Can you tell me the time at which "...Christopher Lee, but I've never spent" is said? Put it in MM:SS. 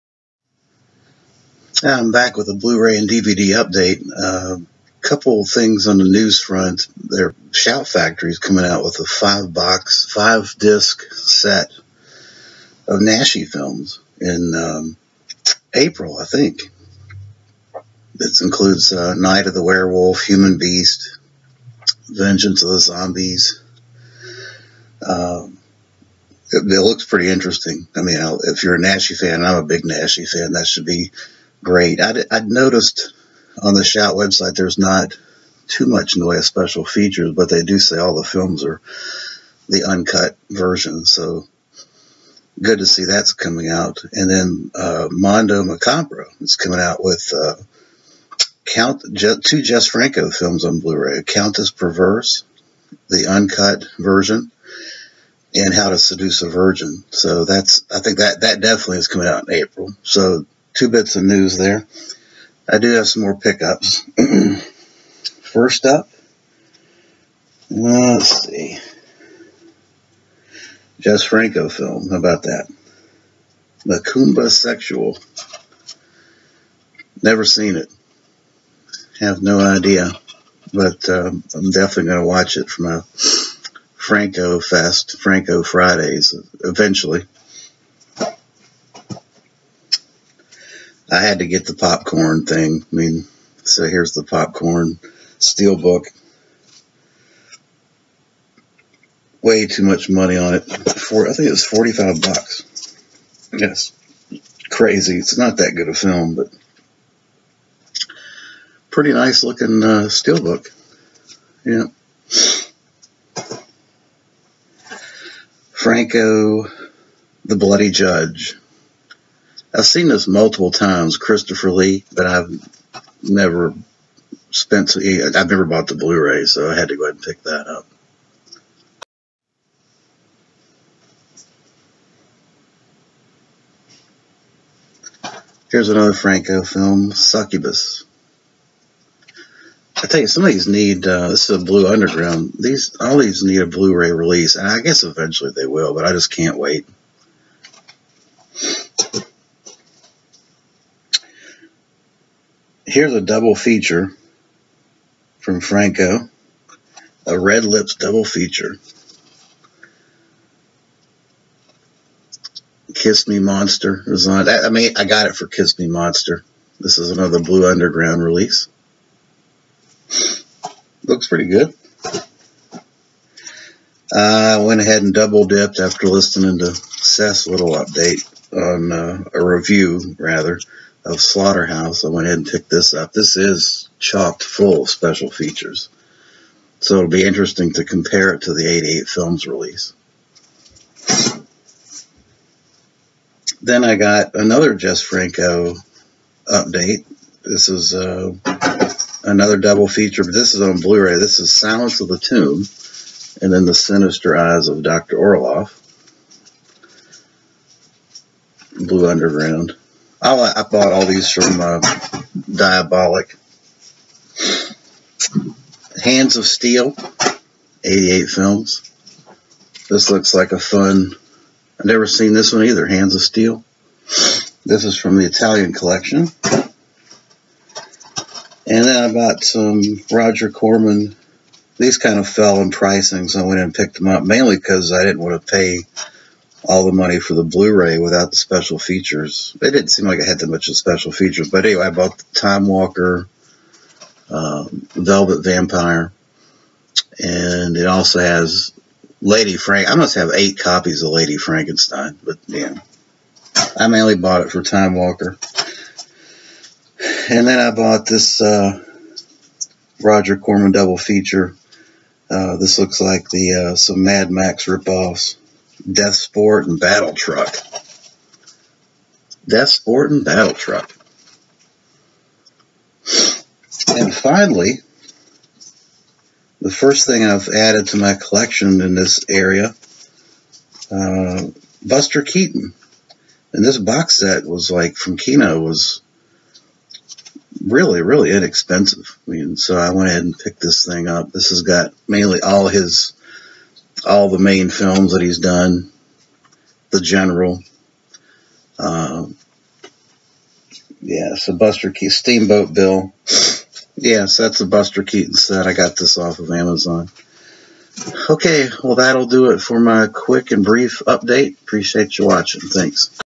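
02:01.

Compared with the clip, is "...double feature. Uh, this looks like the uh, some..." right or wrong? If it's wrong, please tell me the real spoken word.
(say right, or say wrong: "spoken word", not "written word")
right.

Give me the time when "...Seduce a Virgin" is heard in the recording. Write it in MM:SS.
00:55.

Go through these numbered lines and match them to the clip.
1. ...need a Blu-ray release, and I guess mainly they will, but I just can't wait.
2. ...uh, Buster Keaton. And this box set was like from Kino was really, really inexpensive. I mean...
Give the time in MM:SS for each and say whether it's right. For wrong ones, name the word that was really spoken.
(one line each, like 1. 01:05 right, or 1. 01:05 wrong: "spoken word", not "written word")
1. 02:23 wrong: "eventually", not "mainly"
2. 04:40 right.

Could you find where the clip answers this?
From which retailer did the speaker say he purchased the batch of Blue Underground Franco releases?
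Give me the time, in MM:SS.
03:32.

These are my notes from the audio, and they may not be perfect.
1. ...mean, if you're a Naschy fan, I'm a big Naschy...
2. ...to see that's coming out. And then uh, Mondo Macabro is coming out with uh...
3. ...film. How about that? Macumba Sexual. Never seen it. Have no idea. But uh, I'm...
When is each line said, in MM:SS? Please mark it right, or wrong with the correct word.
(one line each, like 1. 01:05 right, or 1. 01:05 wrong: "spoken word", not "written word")
1. 00:28 right
2. 00:42 right
3. 01:11 right.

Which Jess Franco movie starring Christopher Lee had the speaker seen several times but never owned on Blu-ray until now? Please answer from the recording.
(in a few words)
The Bloody Judge.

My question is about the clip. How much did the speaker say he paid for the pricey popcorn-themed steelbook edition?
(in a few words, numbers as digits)
45 bucks.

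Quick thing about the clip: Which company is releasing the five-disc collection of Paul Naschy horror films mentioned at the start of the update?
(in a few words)
Shout Factory.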